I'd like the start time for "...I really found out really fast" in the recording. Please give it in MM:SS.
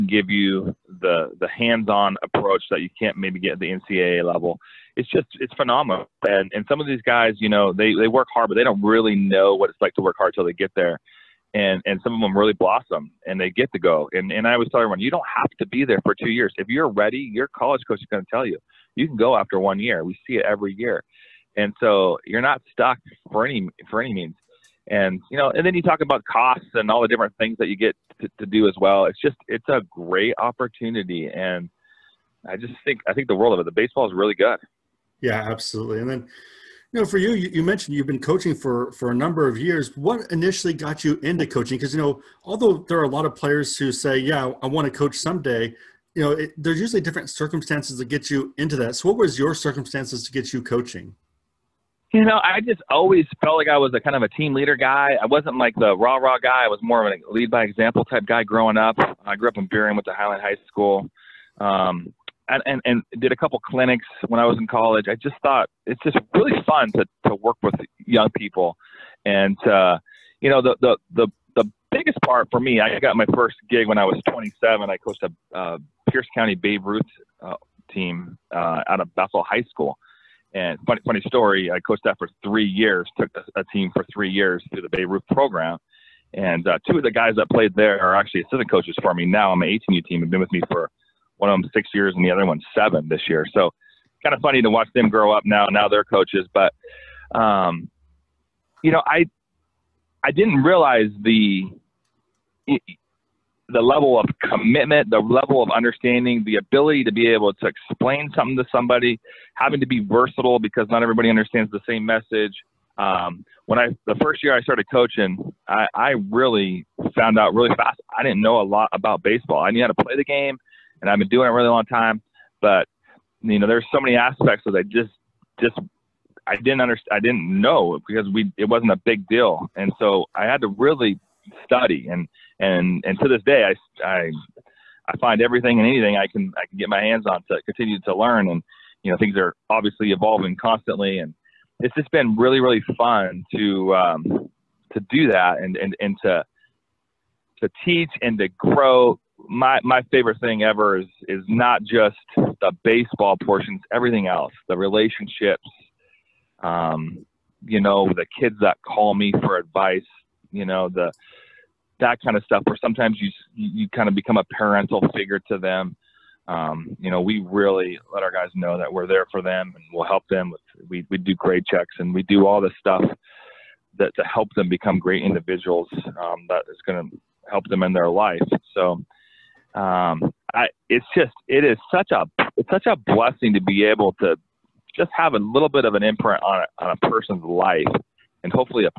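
01:55.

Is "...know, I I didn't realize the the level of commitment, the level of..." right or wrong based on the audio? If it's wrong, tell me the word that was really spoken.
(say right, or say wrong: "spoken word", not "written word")
right.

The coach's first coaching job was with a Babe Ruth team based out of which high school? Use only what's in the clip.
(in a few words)
Bethel High School.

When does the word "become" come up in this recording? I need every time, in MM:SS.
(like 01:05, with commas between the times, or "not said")
02:44, 02:54.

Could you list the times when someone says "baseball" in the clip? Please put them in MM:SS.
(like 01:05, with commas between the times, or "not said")
00:33, 01:59, 02:32.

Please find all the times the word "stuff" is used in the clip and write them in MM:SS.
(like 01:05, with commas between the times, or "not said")
02:42, 02:52.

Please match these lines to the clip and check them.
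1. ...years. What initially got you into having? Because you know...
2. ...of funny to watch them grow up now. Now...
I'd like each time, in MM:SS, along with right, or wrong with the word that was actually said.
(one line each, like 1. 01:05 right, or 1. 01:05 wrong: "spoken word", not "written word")
1. 00:39 wrong: "coaching", not "having"
2. 01:34 right.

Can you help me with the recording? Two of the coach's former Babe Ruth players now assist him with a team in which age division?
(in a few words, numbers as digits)
18U.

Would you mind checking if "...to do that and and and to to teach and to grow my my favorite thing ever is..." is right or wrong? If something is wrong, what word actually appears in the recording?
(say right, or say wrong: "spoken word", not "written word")
right.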